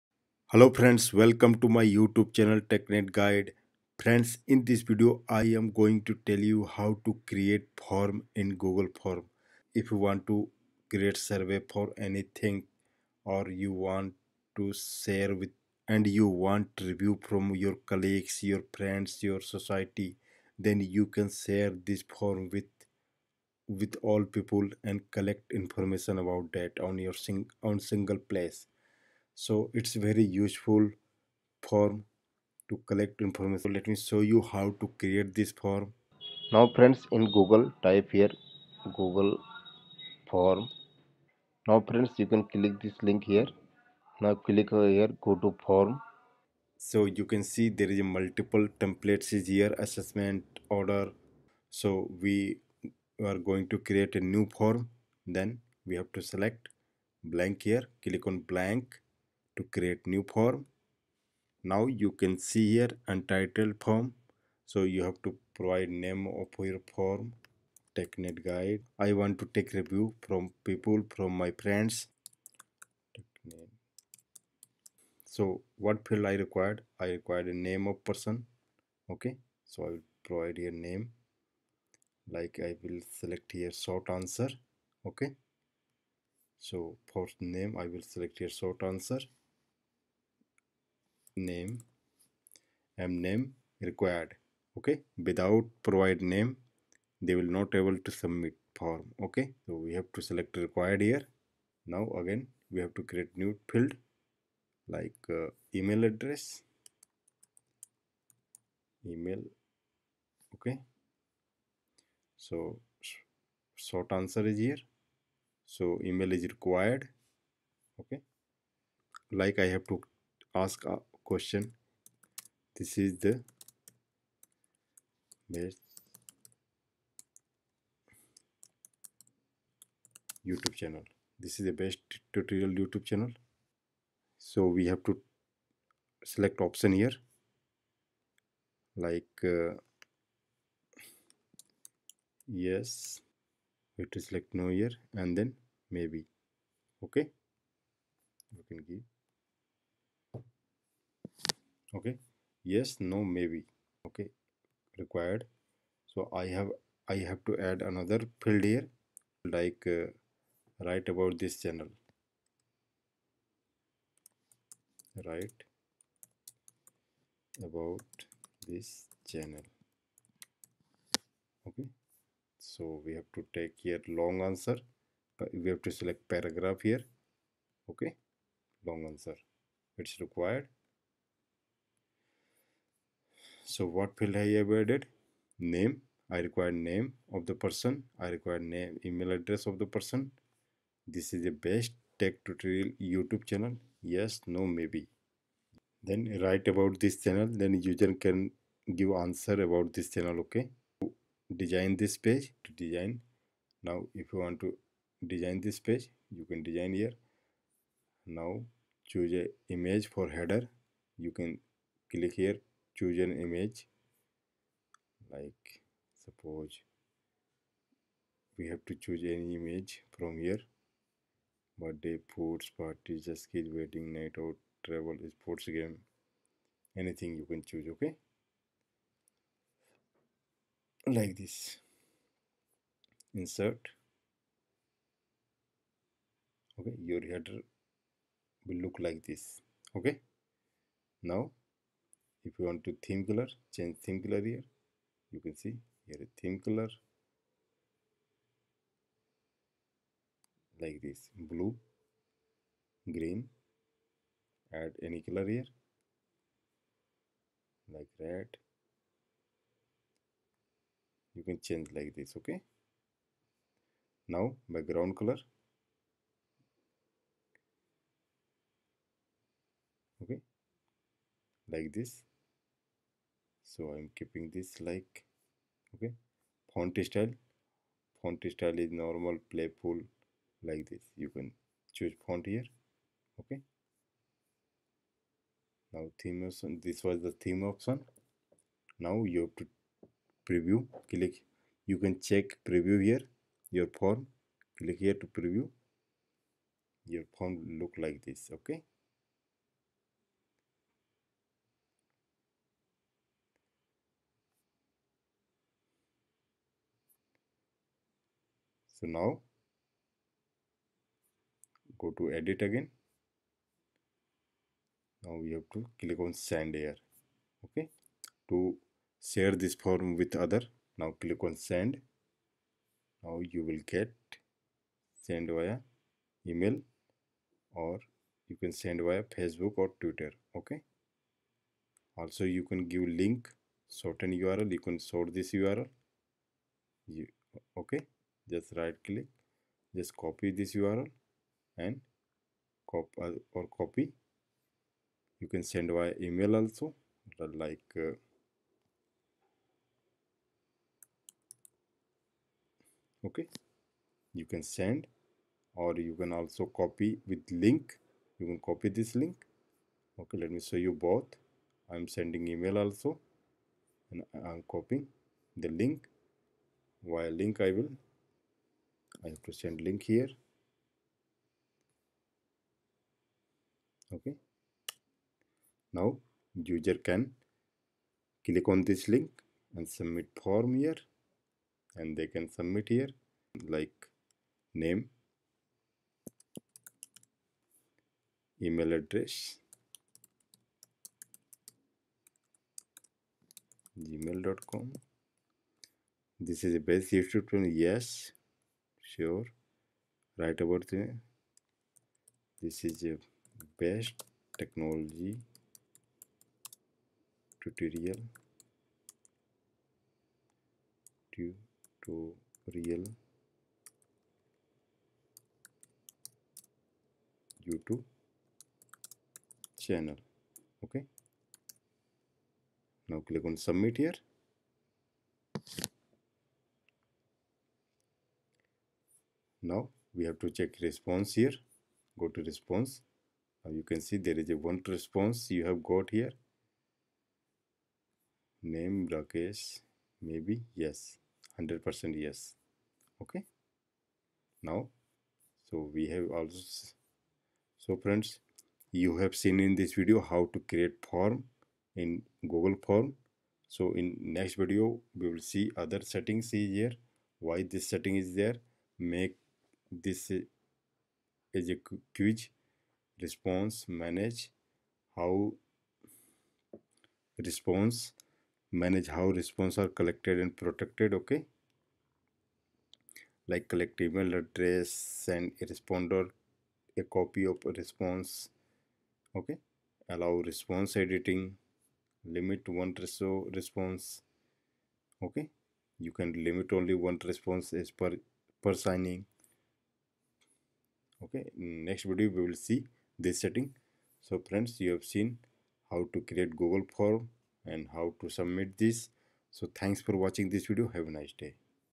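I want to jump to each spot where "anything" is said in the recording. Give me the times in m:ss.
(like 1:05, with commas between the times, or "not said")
0:12, 3:47.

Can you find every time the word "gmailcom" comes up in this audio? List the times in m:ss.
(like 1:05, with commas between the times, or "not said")
6:34.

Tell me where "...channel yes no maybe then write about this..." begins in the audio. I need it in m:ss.
3:13.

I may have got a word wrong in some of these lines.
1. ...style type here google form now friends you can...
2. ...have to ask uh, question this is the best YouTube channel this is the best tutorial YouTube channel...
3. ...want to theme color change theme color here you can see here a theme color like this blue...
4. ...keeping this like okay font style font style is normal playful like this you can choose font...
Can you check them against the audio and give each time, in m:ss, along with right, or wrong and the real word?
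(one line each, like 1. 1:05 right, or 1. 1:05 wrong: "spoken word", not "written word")
1. 0:37 wrong: "google", not "style"
2. 1:59 right
3. 4:02 right
4. 4:34 right.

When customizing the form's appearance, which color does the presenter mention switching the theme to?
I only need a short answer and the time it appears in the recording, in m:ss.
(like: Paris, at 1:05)
Red, at 4:18.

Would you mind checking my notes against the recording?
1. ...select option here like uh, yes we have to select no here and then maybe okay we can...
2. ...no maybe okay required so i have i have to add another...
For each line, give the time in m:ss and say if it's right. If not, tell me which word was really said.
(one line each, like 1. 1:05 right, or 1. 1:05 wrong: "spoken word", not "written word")
1. 2:16 right
2. 2:33 right.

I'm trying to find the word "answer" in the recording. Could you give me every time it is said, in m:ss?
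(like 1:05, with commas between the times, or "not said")
1:24, 1:28, 1:54, 2:54, 2:59, 3:19.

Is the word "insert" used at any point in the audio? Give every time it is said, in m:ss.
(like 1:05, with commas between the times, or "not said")
3:53.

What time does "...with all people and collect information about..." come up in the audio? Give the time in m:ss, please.
0:23.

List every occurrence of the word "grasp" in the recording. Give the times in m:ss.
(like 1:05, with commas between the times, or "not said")
not said.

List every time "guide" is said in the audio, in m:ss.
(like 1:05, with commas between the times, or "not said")
0:03, 1:08.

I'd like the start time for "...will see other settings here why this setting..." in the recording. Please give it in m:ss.
7:35.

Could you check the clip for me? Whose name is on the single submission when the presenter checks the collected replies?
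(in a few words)
Rakesh.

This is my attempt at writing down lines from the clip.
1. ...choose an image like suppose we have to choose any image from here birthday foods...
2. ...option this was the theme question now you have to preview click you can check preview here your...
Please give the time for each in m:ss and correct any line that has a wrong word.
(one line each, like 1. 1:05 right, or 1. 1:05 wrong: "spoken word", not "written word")
1. 3:33 right
2. 4:46 wrong: "option", not "question".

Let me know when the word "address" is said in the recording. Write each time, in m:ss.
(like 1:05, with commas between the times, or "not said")
1:46, 3:09, 6:28, 7:54.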